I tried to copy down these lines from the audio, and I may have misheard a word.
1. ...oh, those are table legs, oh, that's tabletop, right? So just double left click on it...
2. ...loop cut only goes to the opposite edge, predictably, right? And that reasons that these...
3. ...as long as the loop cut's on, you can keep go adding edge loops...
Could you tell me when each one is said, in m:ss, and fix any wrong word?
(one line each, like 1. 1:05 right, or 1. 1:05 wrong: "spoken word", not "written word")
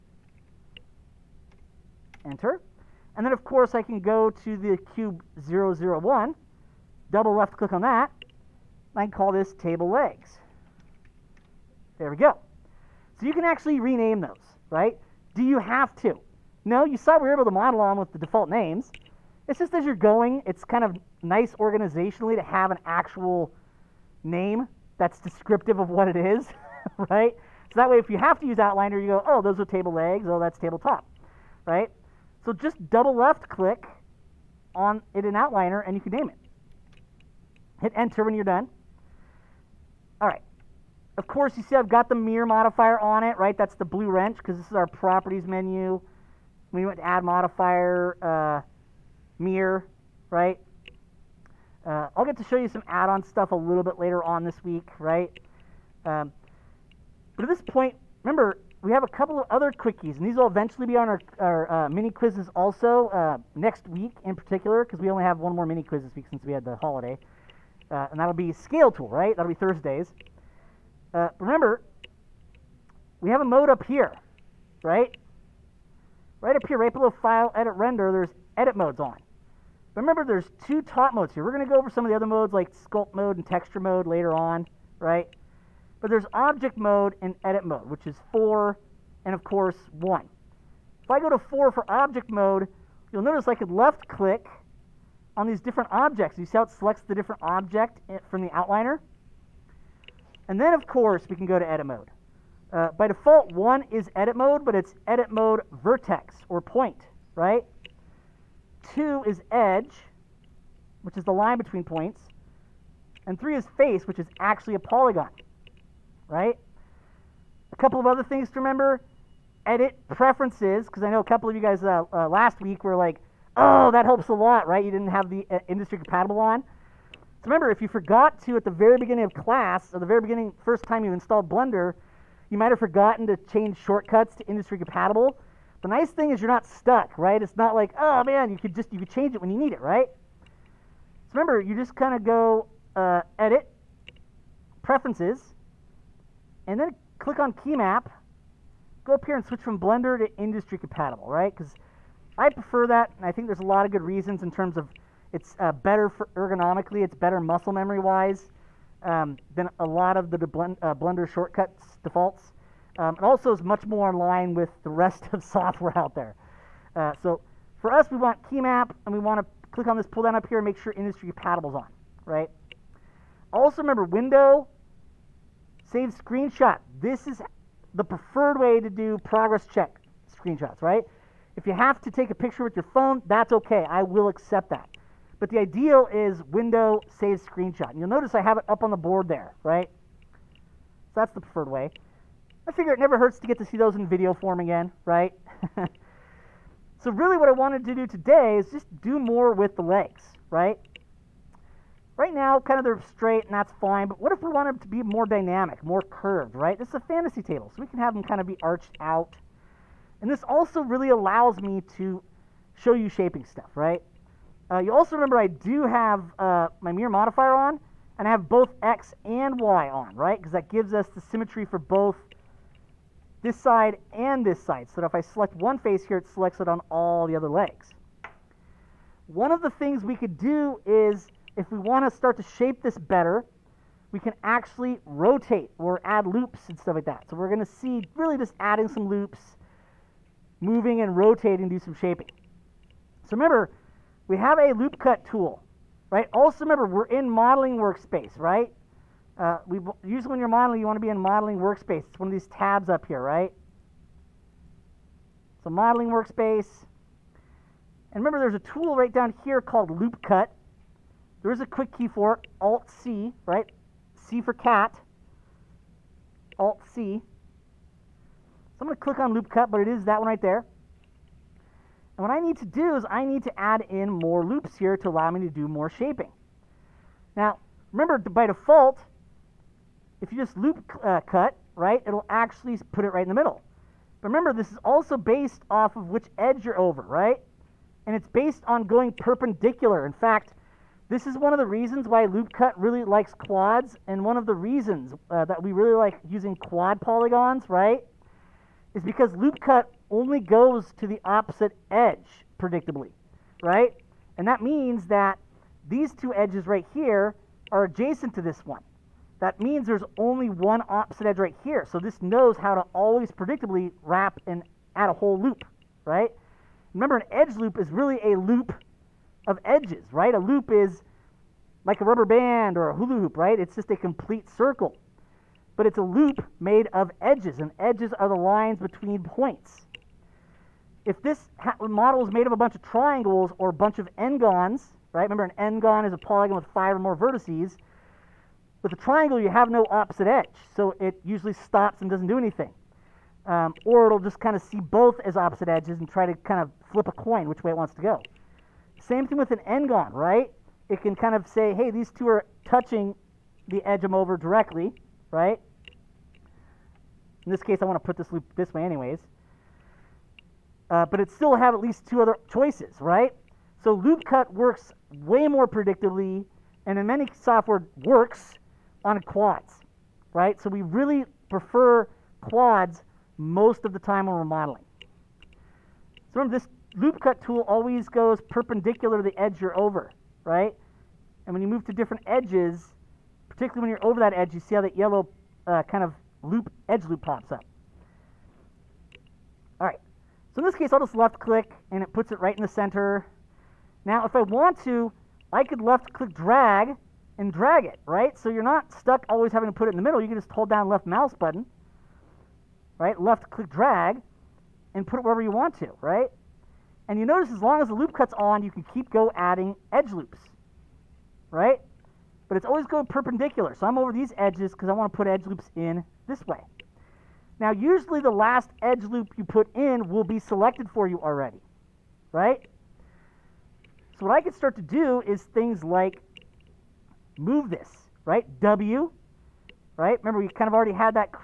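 1. 0:29 right
2. 4:59 wrong: "means", not "reasons"
3. 6:47 right.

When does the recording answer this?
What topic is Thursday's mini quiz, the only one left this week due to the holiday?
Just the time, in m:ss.
1:08.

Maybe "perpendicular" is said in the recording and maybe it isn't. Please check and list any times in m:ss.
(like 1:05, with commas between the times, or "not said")
4:49, 6:18, 6:53.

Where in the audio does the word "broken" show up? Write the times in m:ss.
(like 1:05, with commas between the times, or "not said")
not said.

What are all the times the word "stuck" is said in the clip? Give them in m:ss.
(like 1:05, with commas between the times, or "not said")
2:16, 6:38.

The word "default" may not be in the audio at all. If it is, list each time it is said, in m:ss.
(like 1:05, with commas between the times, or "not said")
0:18, 1:43, 2:42, 4:38.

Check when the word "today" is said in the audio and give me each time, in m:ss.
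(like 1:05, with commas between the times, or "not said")
3:18.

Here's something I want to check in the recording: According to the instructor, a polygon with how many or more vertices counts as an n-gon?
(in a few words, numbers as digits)
5.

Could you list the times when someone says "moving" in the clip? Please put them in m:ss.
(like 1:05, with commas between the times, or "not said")
4:00.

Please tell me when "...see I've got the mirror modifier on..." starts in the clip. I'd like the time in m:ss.
0:41.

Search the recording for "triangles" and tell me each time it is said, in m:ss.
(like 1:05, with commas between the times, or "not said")
5:32, 5:38.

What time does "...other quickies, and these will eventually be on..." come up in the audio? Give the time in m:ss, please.
0:59.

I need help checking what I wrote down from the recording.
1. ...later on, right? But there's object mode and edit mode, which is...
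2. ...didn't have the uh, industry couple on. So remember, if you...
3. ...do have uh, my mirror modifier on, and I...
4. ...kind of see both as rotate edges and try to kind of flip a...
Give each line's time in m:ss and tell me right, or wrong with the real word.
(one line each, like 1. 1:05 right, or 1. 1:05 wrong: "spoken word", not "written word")
1. 1:24 right
2. 2:04 wrong: "compatible", not "couple"
3. 3:35 right
4. 5:44 wrong: "opposite", not "rotate".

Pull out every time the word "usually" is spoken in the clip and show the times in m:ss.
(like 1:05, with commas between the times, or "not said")
4:10, 5:41, 6:57.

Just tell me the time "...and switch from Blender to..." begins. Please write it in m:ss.
2:29.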